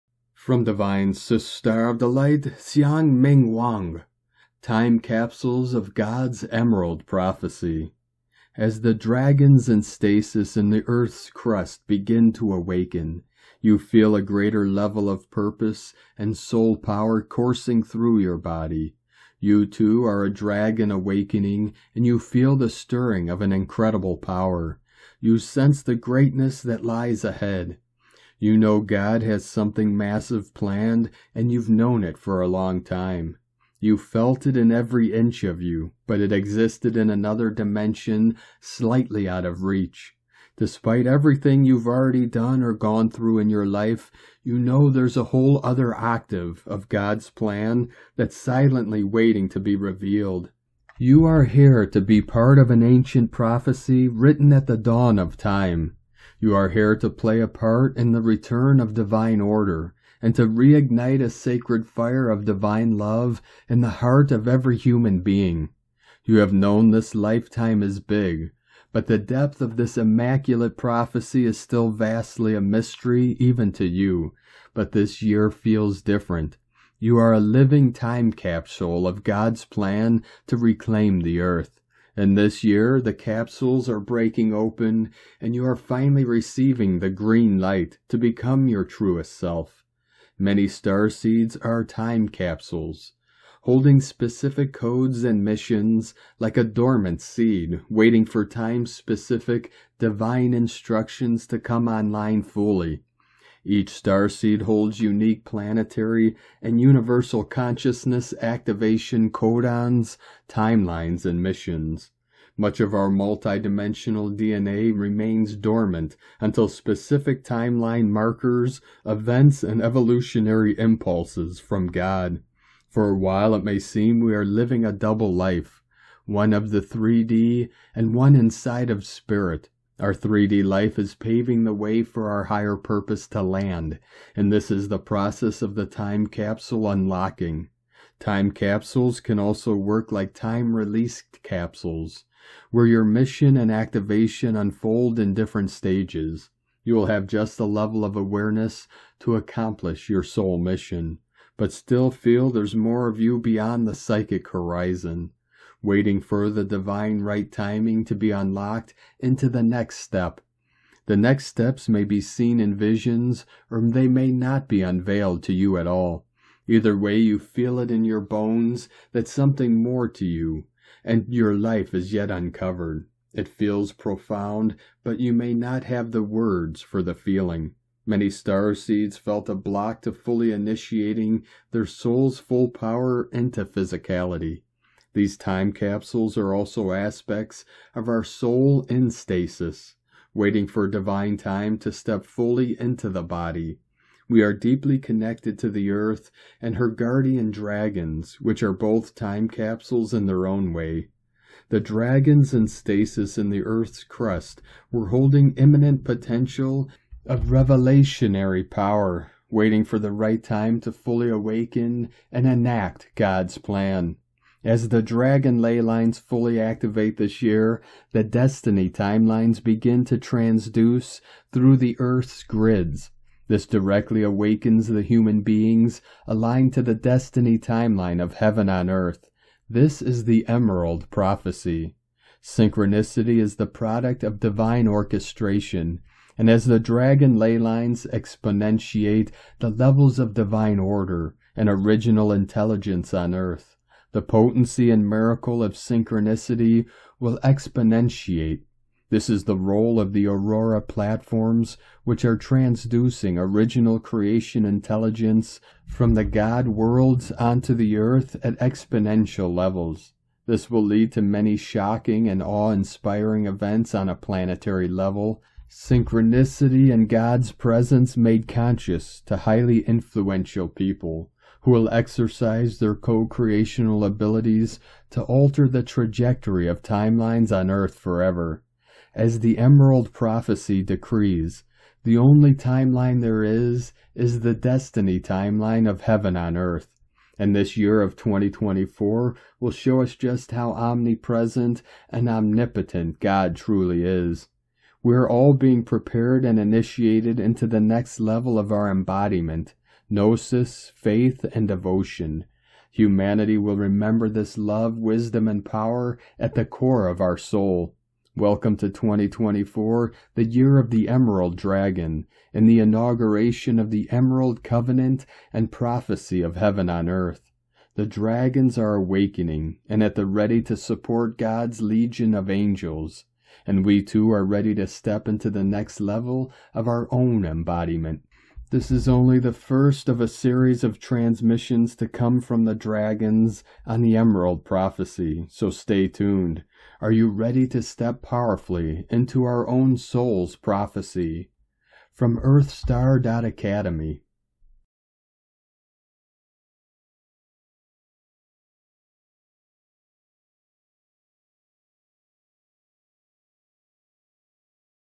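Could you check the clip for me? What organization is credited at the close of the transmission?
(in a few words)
EarthStar Academy.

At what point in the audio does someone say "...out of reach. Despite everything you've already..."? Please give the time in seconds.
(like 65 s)
39 s.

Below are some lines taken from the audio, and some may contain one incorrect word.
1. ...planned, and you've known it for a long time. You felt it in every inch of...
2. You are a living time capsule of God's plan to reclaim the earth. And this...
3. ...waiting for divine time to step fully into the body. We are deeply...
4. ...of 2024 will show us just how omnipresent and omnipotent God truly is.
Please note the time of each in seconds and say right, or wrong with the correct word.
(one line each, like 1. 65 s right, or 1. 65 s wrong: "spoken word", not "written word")
1. 30 s right
2. 76 s right
3. 190 s right
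4. 288 s right.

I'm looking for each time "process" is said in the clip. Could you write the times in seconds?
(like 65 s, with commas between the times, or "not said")
134 s.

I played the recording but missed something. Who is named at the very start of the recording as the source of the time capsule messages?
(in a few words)
Xiang Ming Wang.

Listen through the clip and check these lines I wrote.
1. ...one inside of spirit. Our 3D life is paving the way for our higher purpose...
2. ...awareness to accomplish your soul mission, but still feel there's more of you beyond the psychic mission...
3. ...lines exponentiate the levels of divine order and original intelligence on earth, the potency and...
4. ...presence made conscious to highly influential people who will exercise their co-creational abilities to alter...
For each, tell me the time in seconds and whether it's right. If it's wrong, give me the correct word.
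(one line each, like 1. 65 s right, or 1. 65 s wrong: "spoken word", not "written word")
1. 128 s right
2. 148 s wrong: "horizon", not "mission"
3. 237 s right
4. 267 s right.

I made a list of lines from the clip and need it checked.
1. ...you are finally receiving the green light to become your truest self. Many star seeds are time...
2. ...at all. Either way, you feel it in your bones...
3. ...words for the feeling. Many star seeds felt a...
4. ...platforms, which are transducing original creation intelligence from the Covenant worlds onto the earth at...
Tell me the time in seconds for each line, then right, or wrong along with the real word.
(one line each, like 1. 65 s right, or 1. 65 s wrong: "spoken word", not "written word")
1. 85 s right
2. 165 s right
3. 176 s right
4. 250 s wrong: "God", not "Covenant".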